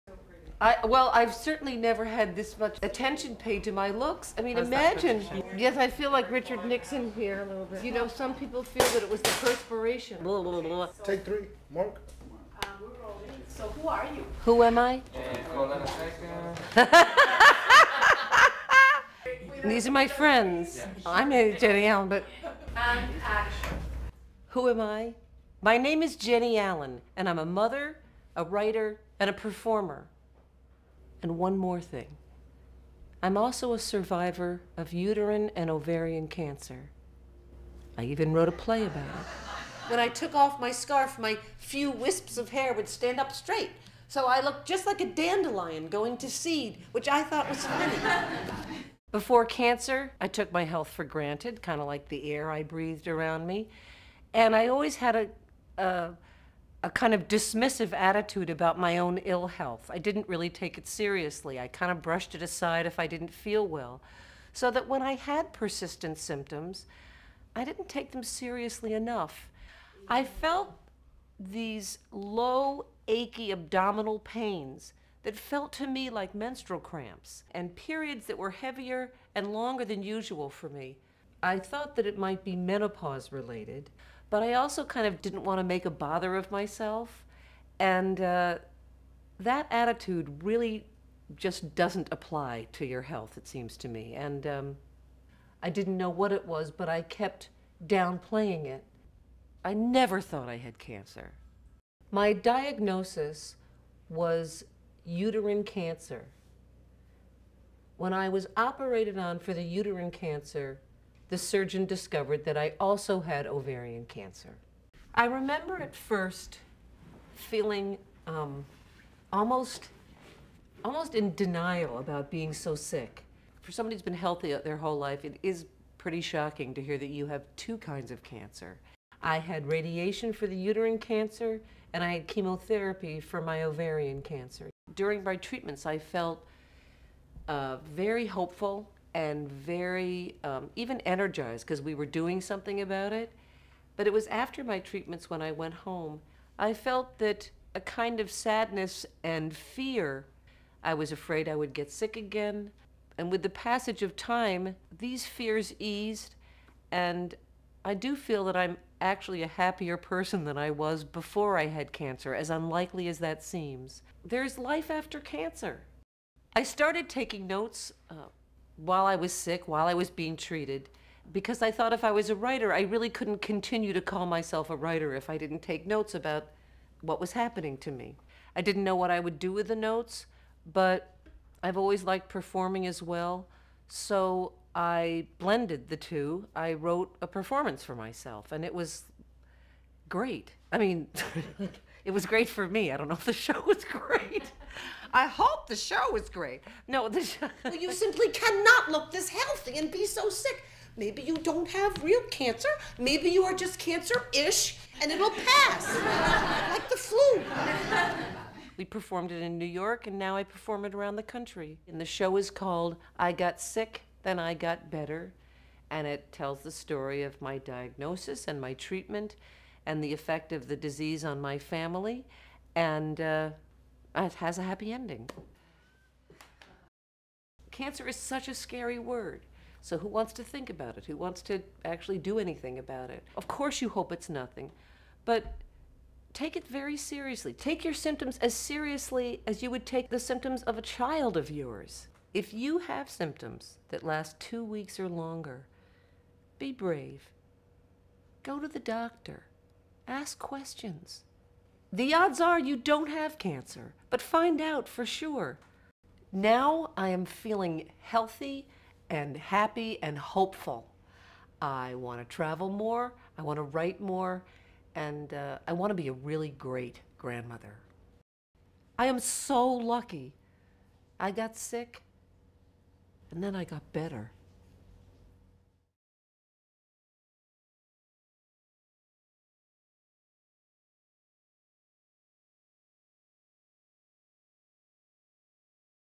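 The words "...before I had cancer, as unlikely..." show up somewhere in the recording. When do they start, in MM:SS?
02:41.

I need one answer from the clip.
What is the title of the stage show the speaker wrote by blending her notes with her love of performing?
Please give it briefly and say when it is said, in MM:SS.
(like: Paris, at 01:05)
I Got Sick, Then I Got Better, at 03:33.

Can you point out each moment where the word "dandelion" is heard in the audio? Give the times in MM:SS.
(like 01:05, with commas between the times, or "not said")
00:45.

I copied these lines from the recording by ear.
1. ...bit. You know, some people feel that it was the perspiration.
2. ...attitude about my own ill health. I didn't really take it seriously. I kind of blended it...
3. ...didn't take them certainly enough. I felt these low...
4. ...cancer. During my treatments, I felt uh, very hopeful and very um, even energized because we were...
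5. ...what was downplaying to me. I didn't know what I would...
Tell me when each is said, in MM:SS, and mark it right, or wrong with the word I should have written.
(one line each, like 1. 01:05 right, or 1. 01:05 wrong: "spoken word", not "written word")
1. 00:07 right
2. 00:57 wrong: "brushed", not "blended"
3. 01:07 wrong: "seriously", not "certainly"
4. 02:14 right
5. 02:57 wrong: "happening", not "downplaying".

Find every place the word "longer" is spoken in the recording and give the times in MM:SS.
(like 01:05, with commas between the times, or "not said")
01:19, 04:05.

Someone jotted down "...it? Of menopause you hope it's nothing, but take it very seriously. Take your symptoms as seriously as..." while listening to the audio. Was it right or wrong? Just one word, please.
wrong.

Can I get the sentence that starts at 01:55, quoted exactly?
I remember at first feeling um, almost, almost in denial about being so sick.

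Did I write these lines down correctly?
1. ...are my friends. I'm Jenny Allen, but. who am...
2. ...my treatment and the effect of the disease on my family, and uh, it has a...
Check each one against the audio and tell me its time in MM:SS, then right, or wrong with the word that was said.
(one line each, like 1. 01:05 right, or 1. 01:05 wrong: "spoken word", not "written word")
1. 00:19 right
2. 03:38 right.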